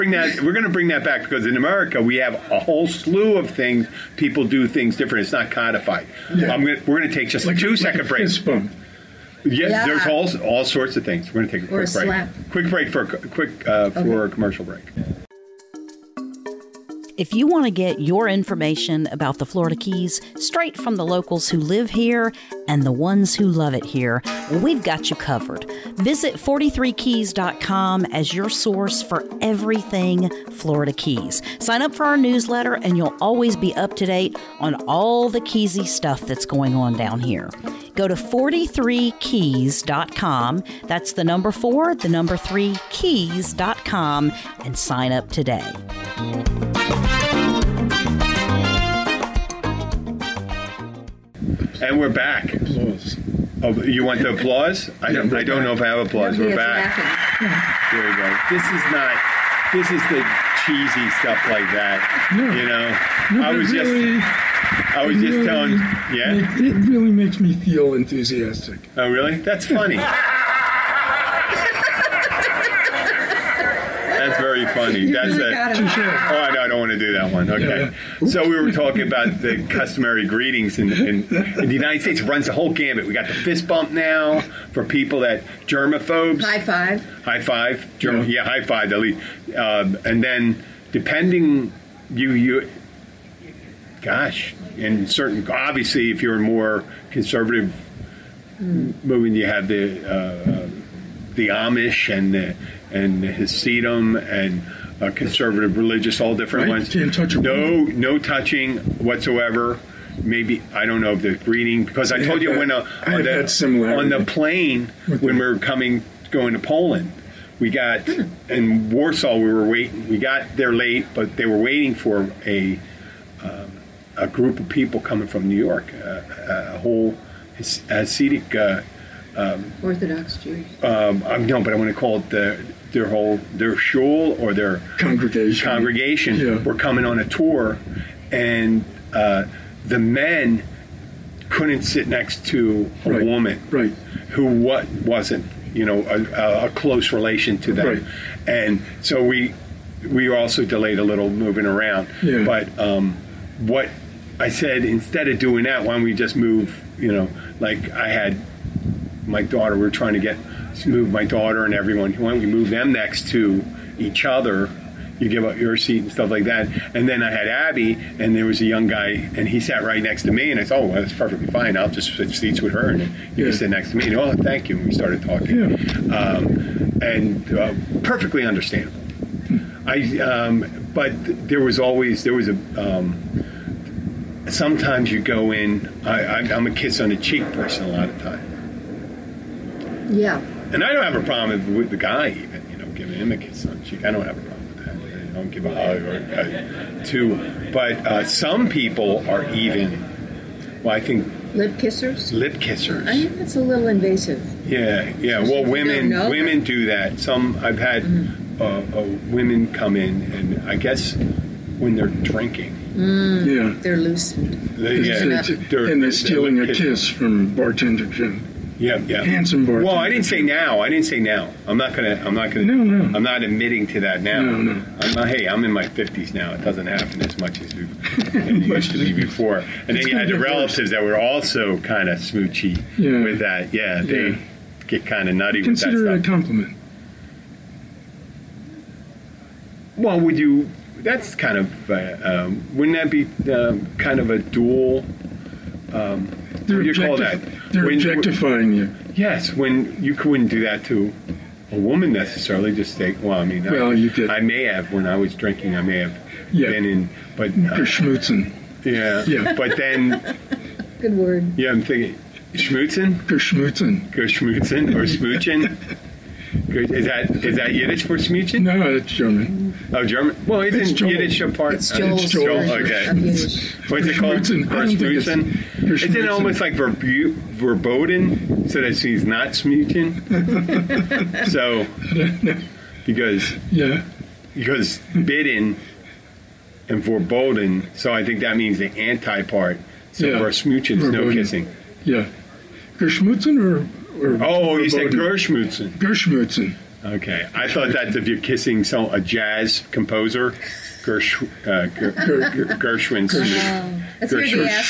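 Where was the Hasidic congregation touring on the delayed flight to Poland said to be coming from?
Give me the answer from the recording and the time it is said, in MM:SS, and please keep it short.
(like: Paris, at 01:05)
New York, at 02:05.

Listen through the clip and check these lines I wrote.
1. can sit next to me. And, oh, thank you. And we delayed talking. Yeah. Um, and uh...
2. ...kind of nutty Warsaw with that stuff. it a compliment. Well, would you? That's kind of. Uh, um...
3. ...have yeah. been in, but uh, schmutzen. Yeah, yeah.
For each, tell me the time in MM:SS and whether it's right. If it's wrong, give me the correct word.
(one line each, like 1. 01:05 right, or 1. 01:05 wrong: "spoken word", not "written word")
1. 02:53 wrong: "started", not "delayed"
2. 03:55 wrong: "Consider", not "Warsaw"
3. 04:15 right.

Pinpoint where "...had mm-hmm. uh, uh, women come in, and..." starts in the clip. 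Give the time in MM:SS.
03:27.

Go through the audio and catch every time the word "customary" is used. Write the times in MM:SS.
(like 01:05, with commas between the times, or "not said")
01:19.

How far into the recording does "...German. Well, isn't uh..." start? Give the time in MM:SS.
04:30.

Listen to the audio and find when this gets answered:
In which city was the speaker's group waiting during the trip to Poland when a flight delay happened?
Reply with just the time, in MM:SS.
01:58.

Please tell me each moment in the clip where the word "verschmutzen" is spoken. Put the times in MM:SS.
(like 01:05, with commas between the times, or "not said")
04:34, 04:50.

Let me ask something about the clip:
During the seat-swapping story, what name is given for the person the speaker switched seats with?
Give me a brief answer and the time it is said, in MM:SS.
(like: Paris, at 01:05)
Abby, at 02:47.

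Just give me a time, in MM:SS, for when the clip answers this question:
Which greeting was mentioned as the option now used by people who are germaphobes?
01:23.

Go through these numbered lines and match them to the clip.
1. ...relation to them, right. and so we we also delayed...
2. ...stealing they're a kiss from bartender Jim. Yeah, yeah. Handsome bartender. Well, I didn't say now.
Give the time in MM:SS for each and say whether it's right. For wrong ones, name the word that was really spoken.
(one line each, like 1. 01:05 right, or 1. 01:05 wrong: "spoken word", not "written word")
1. 02:27 right
2. 03:36 right.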